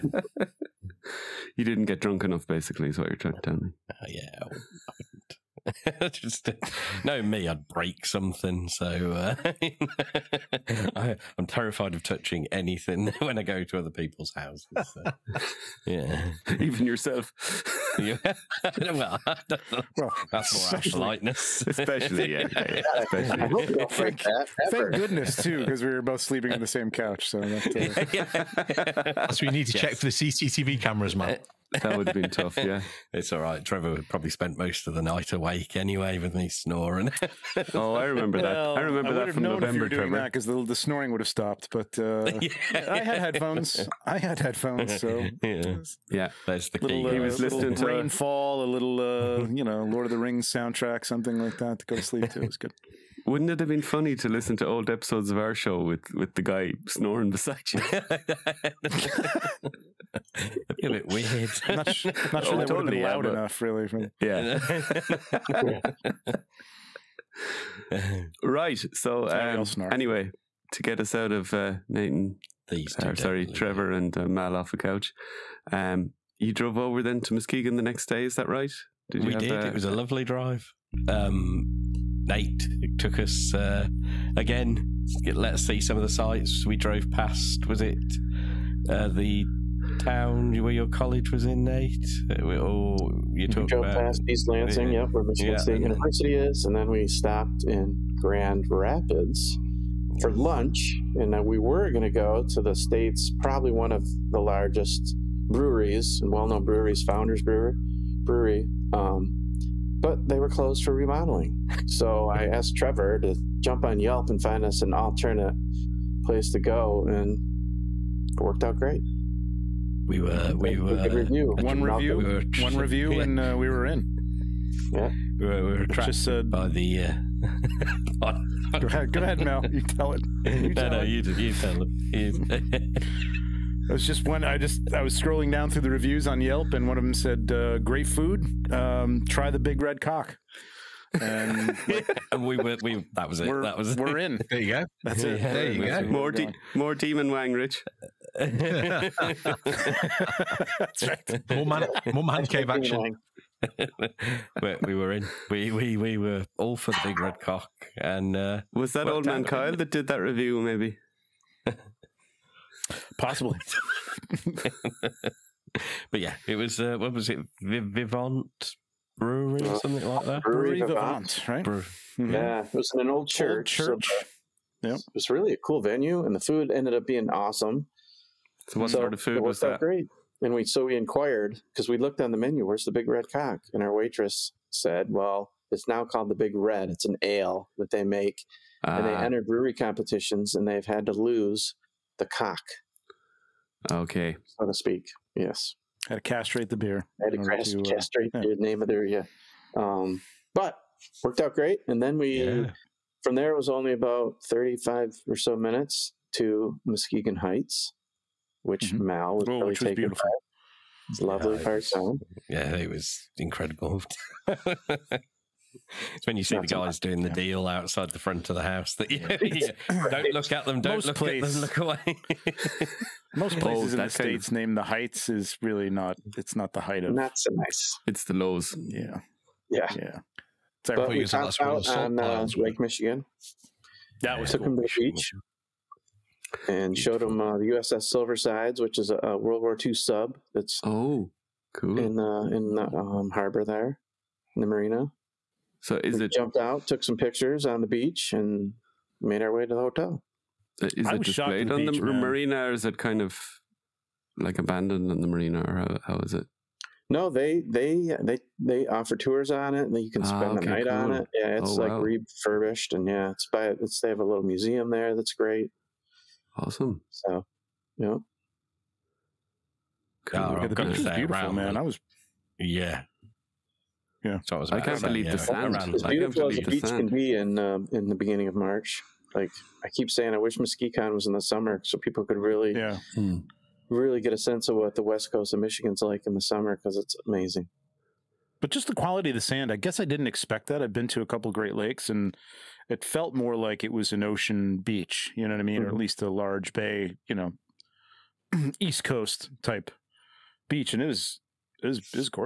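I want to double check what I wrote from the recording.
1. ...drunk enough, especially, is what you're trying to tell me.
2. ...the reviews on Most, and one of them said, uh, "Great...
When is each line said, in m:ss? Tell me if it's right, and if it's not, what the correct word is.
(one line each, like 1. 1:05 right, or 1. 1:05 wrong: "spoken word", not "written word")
1. 0:01 wrong: "basically", not "especially"
2. 2:15 wrong: "Yelp", not "Most".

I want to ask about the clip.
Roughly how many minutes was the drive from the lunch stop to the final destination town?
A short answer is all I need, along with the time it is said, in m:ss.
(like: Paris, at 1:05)
35, at 3:24.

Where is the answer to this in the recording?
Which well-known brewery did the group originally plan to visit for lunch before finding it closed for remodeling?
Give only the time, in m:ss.
1:47.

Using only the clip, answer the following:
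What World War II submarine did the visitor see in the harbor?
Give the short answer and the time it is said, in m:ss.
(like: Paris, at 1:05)
USS Silversides, at 3:57.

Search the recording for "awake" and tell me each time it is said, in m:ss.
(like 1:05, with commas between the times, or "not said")
0:35.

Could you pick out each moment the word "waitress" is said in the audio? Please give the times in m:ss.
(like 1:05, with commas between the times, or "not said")
3:03.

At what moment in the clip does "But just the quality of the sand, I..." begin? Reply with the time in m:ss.
4:48.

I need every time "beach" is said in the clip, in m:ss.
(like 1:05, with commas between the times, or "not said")
3:55, 4:07, 4:11, 4:36, 4:54, 5:00.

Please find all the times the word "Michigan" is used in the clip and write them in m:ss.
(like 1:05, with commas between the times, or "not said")
1:35, 3:52, 4:45.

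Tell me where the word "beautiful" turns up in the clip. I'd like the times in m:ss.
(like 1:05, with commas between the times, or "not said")
3:29, 4:31, 4:36.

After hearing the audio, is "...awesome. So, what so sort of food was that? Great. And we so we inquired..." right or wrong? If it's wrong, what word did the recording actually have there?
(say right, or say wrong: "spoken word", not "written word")
right.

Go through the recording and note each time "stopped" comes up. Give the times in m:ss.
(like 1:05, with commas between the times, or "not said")
0:41, 1:37.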